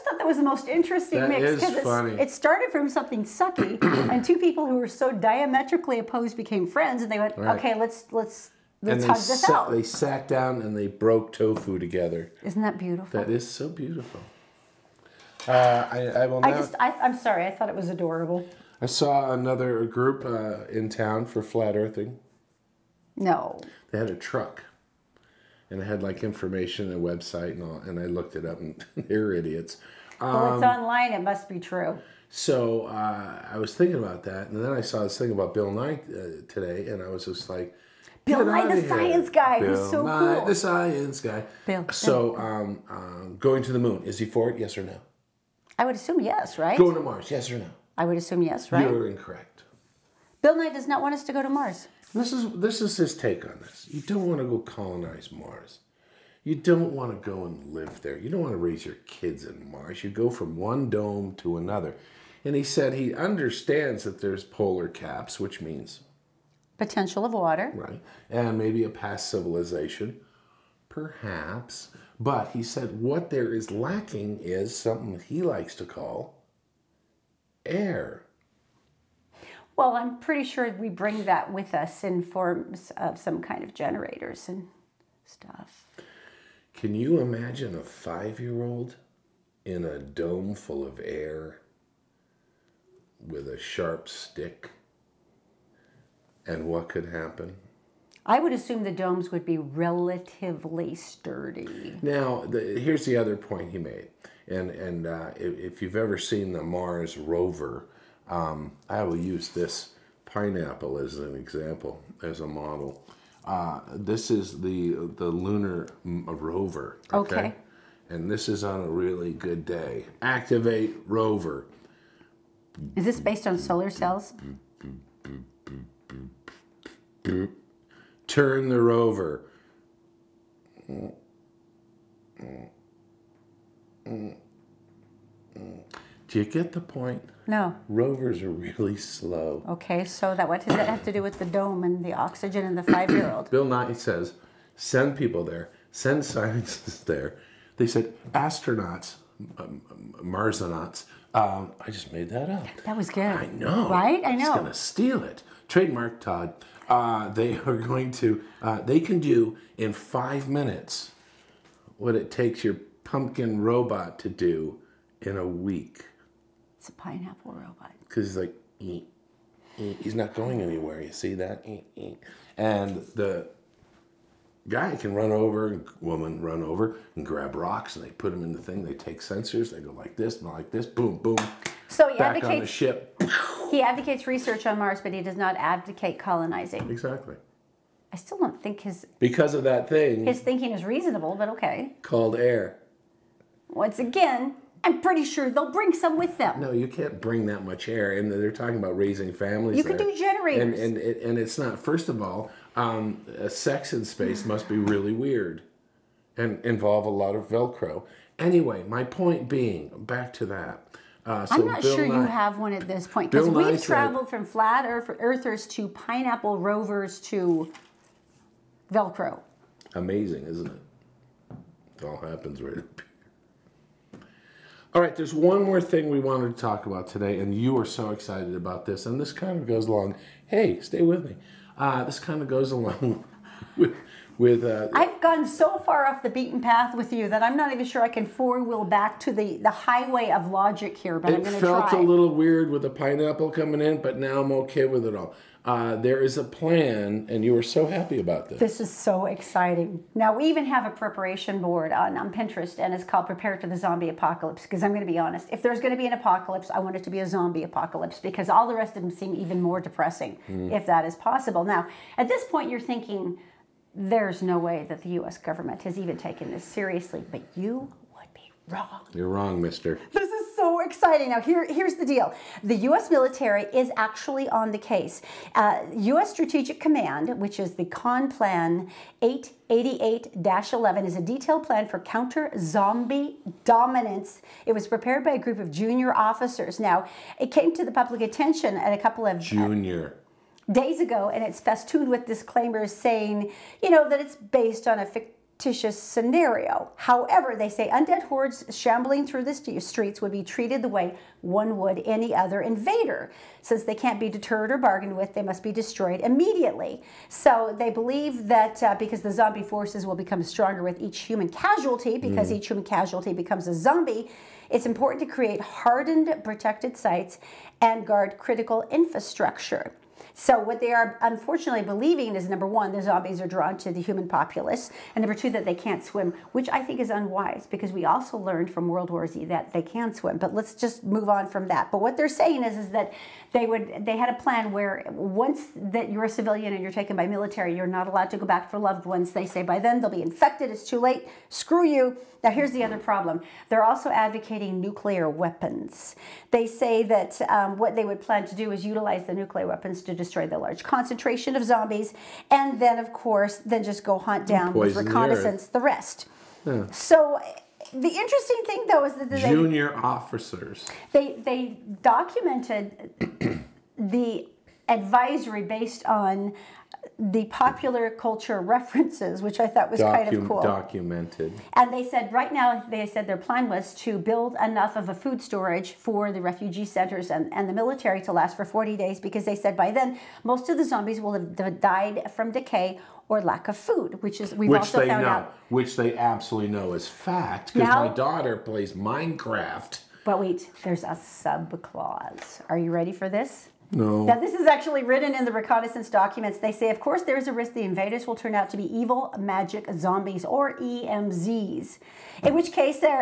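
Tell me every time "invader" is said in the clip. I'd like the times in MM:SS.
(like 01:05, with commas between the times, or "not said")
05:02, 06:37.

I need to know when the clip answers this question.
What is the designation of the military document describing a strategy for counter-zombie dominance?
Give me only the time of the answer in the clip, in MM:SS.
04:37.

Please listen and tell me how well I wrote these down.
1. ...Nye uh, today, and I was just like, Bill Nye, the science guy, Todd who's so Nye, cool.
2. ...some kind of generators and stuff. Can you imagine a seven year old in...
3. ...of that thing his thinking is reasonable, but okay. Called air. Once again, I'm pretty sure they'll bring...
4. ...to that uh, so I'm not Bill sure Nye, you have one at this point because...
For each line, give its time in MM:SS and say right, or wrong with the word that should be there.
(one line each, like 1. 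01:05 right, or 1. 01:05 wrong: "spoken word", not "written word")
1. 00:35 wrong: "Bill", not "Todd"
2. 01:23 wrong: "five", not "seven"
3. 03:09 right
4. 03:30 right.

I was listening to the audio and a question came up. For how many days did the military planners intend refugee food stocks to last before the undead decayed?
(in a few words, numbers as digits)
40.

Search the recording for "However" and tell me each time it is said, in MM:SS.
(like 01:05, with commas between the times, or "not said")
04:56.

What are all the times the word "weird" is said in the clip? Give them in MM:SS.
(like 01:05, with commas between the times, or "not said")
03:25, 04:02.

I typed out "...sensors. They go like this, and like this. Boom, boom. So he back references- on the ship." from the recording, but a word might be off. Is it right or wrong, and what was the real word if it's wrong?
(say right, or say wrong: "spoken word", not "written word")
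wrong: "advocates", not "references".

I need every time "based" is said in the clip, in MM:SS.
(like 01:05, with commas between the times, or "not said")
02:03, 04:54, 06:05.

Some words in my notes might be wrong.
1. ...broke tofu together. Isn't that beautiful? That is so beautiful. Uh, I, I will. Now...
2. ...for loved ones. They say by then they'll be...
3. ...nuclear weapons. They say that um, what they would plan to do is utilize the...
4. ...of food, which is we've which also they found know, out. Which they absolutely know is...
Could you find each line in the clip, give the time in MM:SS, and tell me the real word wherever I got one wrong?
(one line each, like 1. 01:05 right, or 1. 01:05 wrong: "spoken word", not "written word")
1. 00:10 right
2. 05:38 right
3. 05:44 right
4. 06:23 right.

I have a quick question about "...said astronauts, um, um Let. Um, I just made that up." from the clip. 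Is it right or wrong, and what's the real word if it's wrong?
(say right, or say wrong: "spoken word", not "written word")
wrong: "Marsonauts", not "Let".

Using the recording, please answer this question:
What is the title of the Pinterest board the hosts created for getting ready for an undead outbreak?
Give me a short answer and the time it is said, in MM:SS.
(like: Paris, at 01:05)
Prepare to the Zombie Apocalypse, at 04:13.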